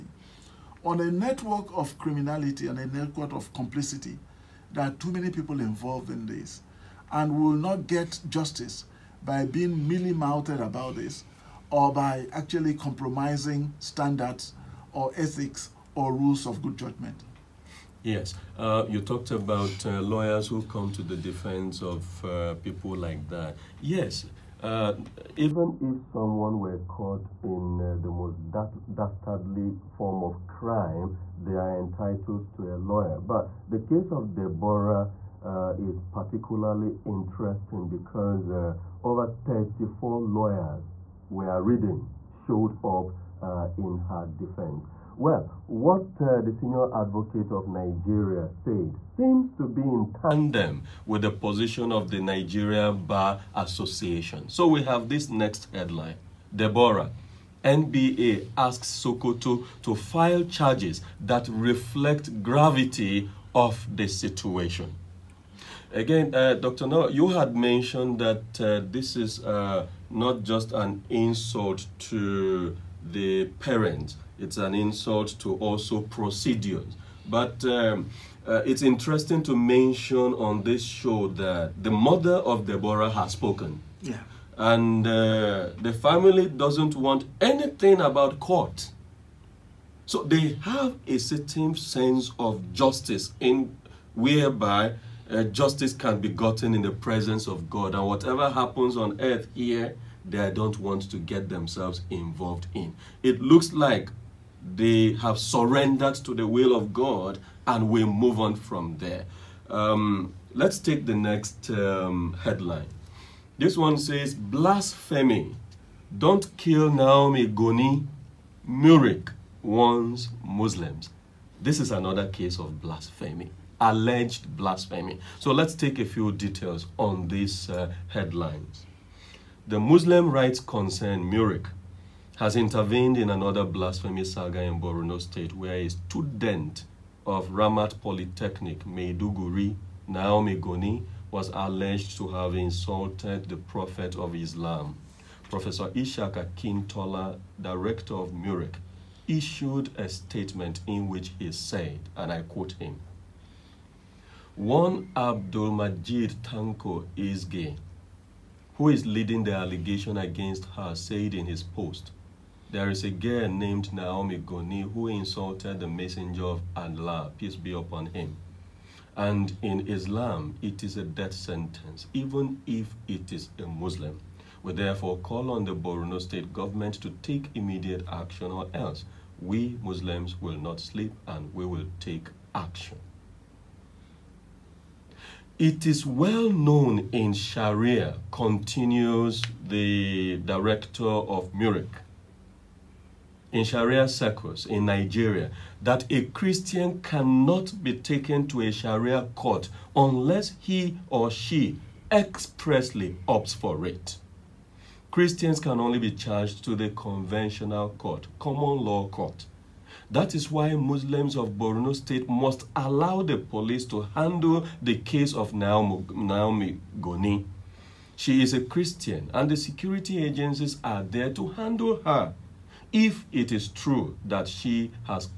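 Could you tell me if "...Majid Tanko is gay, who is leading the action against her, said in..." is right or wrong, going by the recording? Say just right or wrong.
wrong.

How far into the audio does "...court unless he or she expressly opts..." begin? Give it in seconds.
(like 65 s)
199 s.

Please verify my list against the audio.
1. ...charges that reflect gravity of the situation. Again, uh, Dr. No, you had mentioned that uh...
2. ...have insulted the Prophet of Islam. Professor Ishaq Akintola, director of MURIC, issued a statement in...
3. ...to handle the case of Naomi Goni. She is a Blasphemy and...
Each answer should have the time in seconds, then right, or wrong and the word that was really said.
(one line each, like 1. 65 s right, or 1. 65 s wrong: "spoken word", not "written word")
1. 60 s right
2. 142 s right
3. 213 s wrong: "Christian", not "Blasphemy".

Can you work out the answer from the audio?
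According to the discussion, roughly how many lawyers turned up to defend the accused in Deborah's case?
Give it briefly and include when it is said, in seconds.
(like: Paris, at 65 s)
34, at 39 s.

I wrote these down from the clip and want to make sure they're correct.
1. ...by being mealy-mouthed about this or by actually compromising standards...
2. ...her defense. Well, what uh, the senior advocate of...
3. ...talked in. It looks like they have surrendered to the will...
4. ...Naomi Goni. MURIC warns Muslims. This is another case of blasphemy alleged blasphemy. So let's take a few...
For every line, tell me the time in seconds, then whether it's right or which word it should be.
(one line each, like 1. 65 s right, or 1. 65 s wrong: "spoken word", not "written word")
1. 9 s right
2. 43 s right
3. 102 s wrong: "involved", not "talked"
4. 116 s right.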